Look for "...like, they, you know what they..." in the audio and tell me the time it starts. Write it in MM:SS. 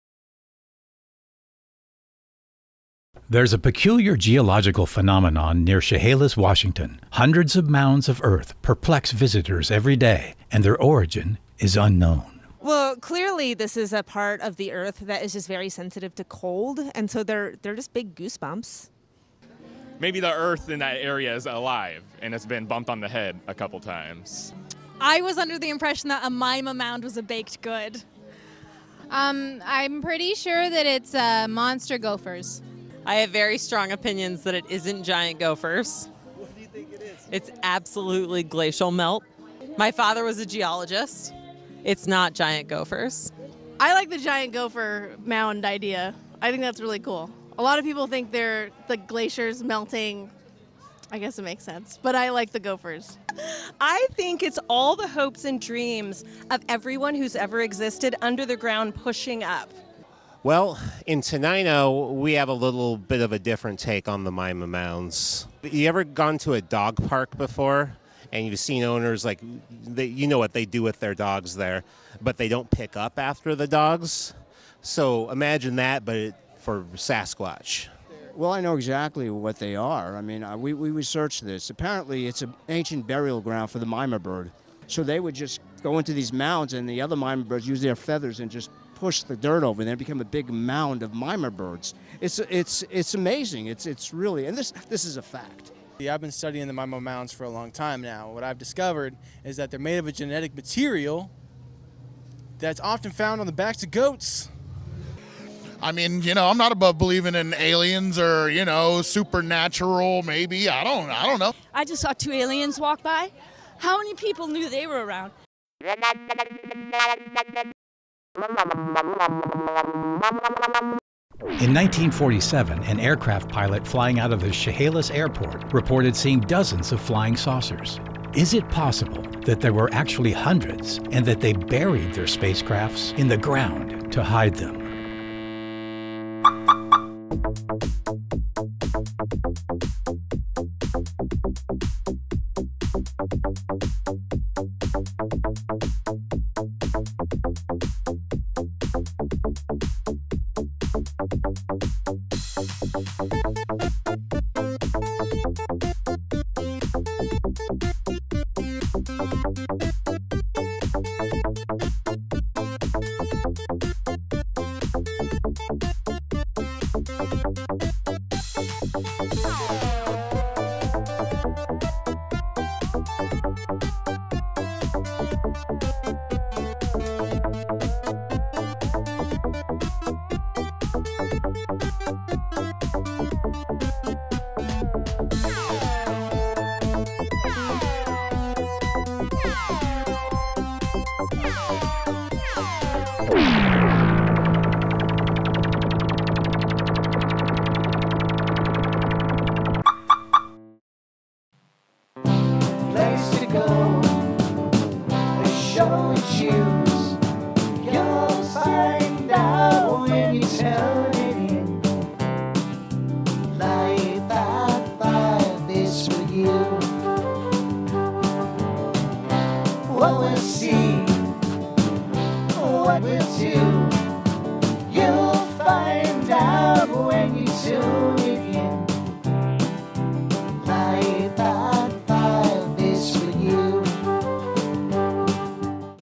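01:09.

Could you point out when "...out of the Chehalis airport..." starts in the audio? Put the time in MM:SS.
02:04.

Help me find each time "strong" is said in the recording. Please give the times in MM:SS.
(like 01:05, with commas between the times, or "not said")
00:33.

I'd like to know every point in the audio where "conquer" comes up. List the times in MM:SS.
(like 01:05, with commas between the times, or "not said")
not said.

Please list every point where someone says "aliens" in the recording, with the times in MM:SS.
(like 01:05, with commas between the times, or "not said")
01:47, 01:52.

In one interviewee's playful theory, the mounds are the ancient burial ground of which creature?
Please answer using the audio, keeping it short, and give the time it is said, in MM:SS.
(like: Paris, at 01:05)
Mima bird, at 01:23.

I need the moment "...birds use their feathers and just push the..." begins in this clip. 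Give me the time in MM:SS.
01:27.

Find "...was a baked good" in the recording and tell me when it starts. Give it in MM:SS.
00:27.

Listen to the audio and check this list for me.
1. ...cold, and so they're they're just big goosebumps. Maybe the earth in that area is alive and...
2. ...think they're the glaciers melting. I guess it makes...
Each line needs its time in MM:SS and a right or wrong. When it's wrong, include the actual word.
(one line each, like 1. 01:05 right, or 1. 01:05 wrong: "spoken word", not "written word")
1. 00:16 right
2. 00:48 right.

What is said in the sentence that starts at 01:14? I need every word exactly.
So imagine that, but it, for Sasquatch.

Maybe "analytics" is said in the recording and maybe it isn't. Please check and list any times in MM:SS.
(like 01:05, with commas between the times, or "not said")
not said.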